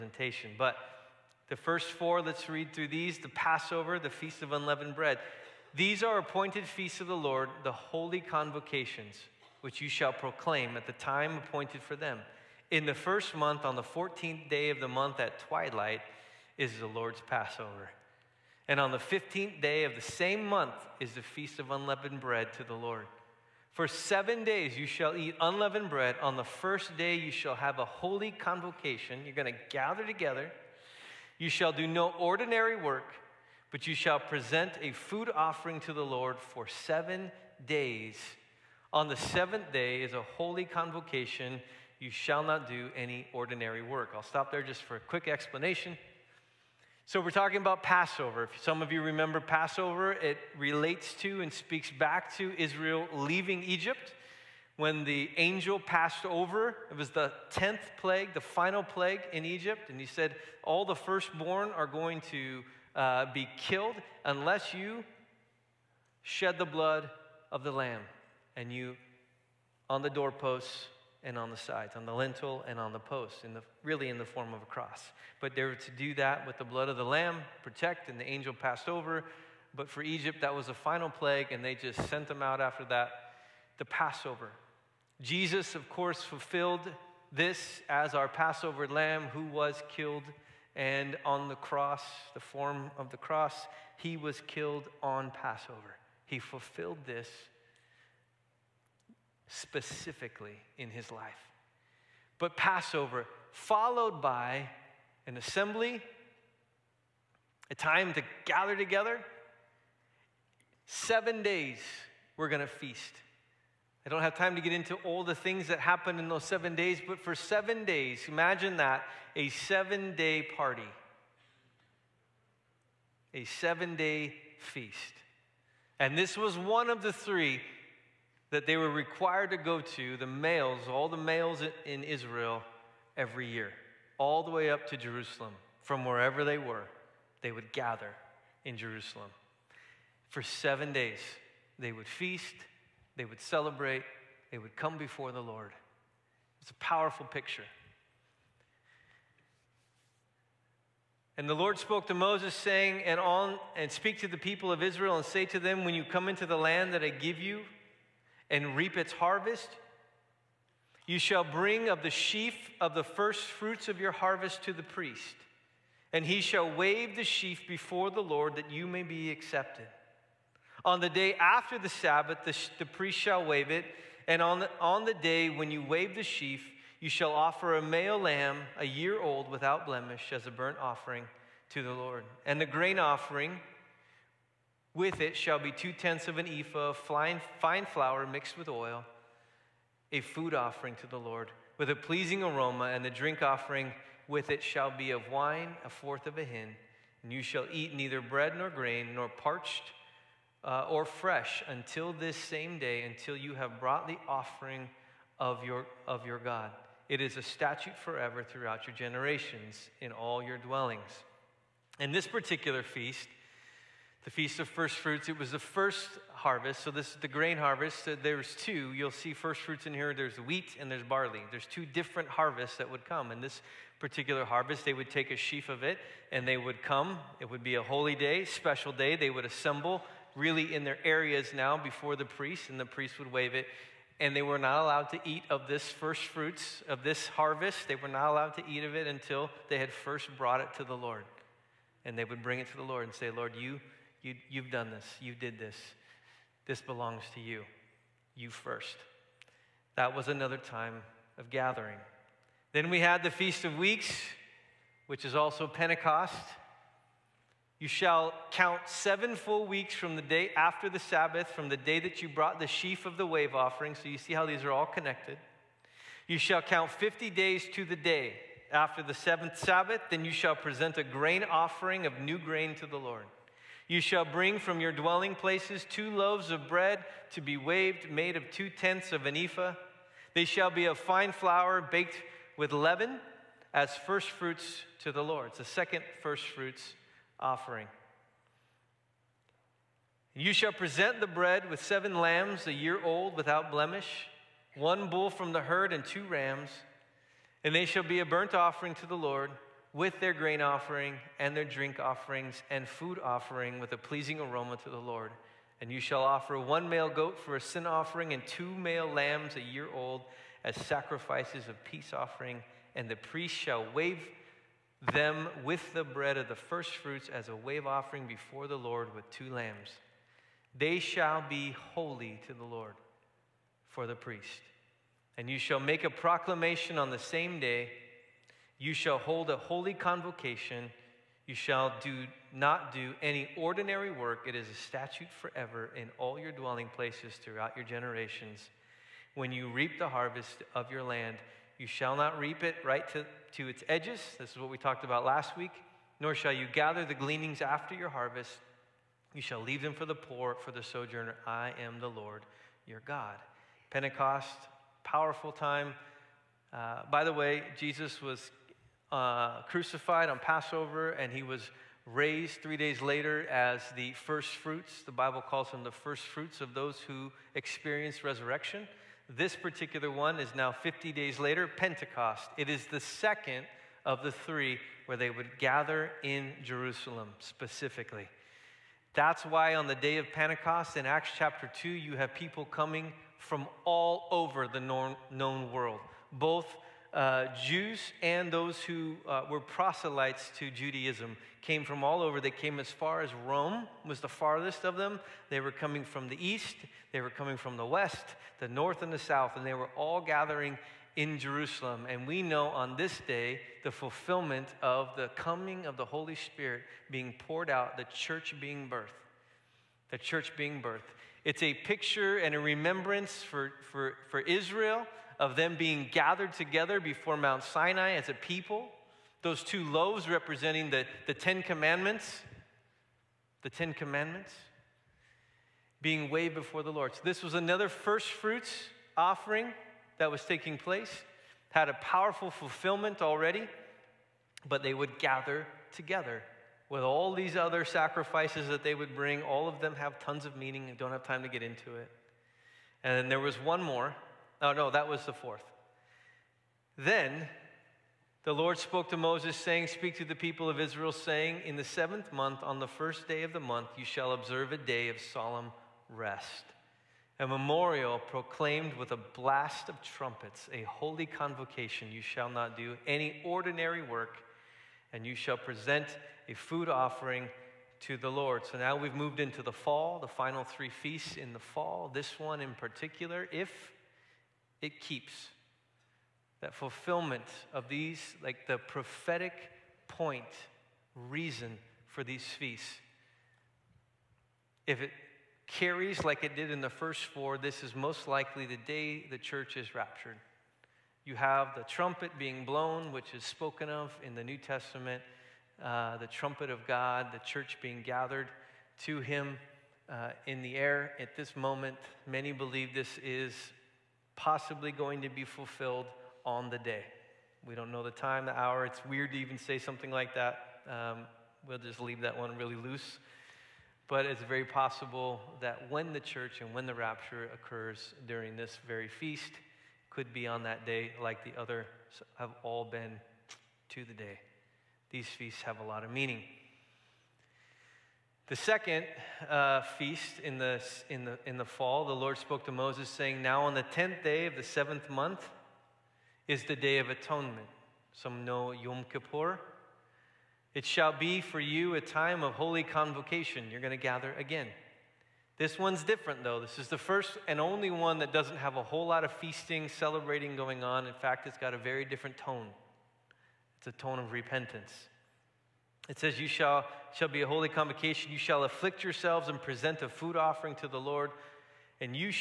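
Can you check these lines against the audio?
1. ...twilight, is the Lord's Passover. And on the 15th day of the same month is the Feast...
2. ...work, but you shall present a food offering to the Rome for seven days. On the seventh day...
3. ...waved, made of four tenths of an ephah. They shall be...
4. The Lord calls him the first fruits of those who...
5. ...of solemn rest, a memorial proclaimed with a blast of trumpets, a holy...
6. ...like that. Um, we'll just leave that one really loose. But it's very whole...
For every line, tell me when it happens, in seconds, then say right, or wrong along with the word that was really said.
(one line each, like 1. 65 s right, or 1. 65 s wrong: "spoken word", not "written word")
1. 15 s right
2. 32 s wrong: "Lord", not "Rome"
3. 277 s wrong: "two", not "four"
4. 365 s wrong: "Bible", not "Lord"
5. 455 s right
6. 510 s wrong: "possible", not "whole".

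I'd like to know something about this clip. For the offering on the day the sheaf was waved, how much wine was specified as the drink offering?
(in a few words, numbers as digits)
A fourth of a hin.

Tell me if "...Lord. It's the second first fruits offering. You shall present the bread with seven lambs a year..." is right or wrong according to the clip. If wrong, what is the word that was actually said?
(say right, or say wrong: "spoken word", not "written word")
right.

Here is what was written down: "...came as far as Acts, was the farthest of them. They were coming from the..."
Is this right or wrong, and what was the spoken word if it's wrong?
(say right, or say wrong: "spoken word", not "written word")
wrong: "Rome", not "Acts".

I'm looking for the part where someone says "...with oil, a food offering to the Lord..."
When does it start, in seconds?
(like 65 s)
188 s.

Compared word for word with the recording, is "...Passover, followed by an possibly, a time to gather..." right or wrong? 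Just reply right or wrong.
wrong.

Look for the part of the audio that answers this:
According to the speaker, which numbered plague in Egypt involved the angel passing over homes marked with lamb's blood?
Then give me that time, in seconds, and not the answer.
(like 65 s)
57 s.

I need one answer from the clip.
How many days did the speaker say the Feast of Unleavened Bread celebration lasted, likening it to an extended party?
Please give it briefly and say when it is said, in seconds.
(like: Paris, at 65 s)
7, at 119 s.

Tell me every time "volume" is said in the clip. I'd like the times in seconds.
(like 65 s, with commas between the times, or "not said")
not said.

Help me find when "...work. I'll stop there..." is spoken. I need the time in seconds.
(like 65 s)
43 s.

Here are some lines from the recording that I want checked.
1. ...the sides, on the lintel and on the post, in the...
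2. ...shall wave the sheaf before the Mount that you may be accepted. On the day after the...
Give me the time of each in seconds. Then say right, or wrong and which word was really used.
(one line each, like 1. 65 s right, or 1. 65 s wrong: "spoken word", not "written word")
1. 71 s right
2. 166 s wrong: "Lord", not "Mount".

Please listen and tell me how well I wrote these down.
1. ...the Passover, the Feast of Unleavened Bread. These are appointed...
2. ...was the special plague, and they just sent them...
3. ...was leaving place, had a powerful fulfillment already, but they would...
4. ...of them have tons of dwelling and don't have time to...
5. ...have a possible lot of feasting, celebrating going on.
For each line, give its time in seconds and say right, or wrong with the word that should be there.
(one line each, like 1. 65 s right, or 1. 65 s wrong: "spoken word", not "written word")
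1. 3 s right
2. 80 s wrong: "final", not "special"
3. 430 s wrong: "taking", not "leaving"
4. 439 s wrong: "meaning", not "dwelling"
5. 548 s wrong: "whole", not "possible".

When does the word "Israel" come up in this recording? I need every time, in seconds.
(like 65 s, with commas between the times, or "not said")
52 s, 132 s, 154 s, 414 s, 450 s.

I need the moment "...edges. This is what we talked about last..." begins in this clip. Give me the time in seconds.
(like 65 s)
343 s.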